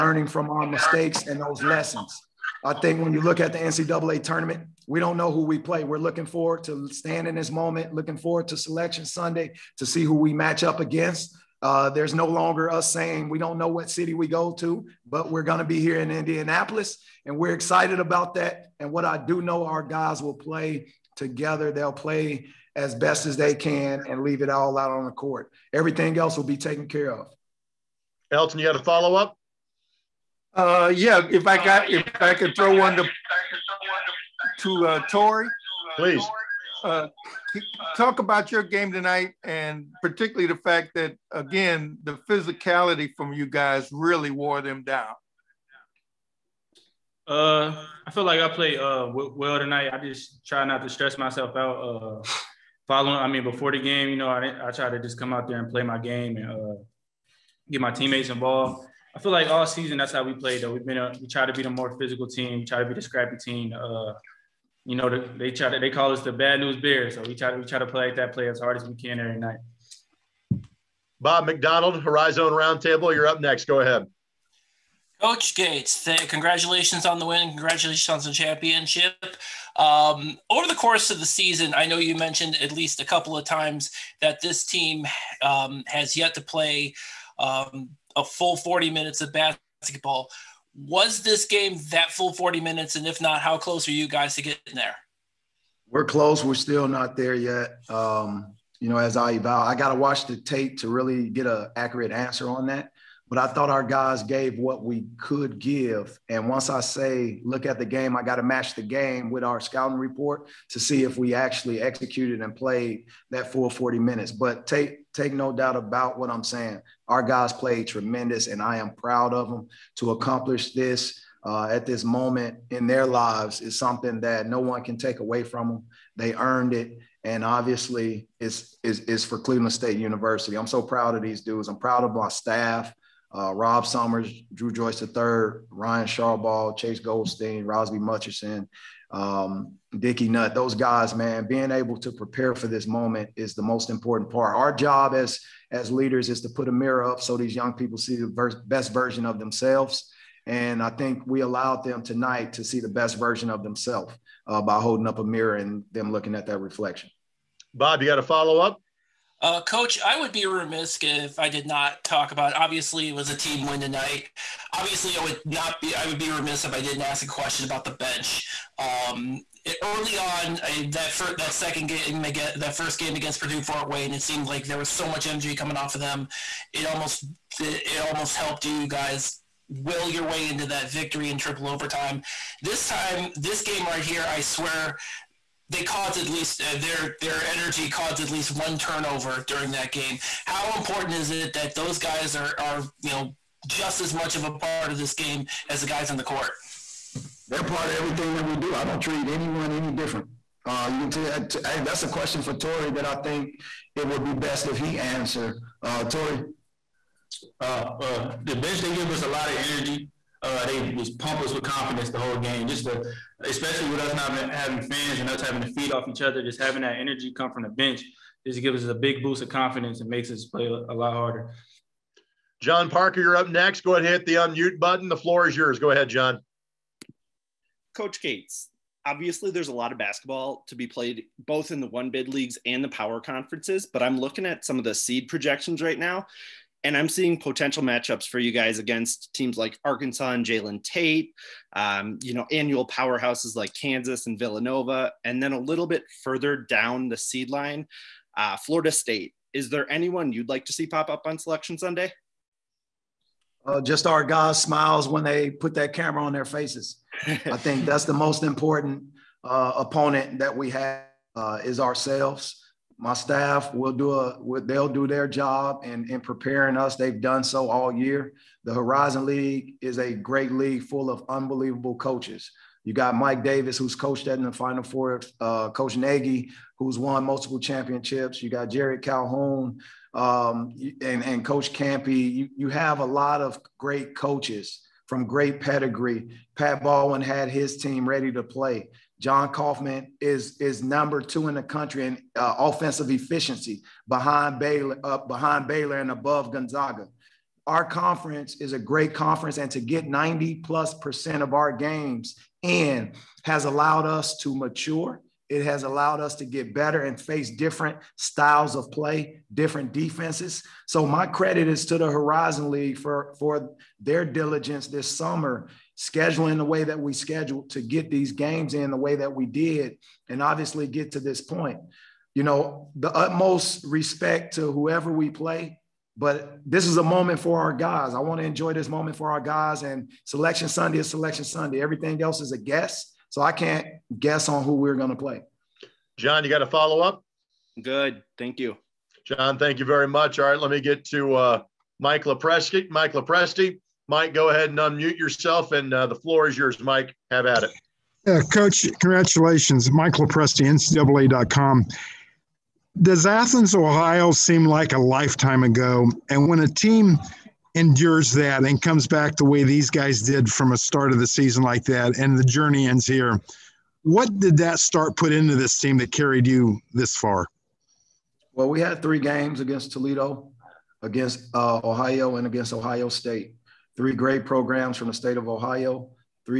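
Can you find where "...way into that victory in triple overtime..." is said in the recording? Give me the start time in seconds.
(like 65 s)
180 s.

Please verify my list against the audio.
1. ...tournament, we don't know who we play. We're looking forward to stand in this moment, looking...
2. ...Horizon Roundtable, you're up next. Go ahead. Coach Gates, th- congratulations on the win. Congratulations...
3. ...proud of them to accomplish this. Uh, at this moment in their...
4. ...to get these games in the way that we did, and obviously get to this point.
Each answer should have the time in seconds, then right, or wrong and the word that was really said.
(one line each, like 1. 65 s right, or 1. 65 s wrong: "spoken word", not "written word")
1. 4 s right
2. 72 s right
3. 118 s right
4. 317 s right.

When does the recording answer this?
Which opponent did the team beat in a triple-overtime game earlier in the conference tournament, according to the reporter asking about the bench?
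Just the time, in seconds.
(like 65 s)
173 s.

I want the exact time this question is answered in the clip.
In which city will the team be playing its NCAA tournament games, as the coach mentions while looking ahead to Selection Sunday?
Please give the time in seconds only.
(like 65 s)
16 s.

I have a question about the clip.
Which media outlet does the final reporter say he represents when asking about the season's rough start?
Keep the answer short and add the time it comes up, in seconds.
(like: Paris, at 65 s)
NCAA.com, at 350 s.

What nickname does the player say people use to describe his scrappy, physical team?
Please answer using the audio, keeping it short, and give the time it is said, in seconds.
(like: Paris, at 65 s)
Bad News Bears, at 66 s.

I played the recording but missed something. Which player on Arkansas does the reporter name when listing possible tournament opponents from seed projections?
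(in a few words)
Jalen Tate.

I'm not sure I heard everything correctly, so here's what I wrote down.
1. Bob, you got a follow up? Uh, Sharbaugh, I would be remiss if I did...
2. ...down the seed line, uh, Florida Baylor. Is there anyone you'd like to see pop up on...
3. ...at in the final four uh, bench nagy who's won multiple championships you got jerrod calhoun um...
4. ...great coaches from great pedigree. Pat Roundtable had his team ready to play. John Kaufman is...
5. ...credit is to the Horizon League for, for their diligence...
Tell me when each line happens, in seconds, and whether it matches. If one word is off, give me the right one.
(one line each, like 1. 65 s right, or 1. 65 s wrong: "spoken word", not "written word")
1. 157 s wrong: "Coach", not "Sharbaugh"
2. 246 s wrong: "State", not "Baylor"
3. 274 s wrong: "coach", not "bench"
4. 283 s wrong: "Baldwin", not "Roundtable"
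5. 311 s right.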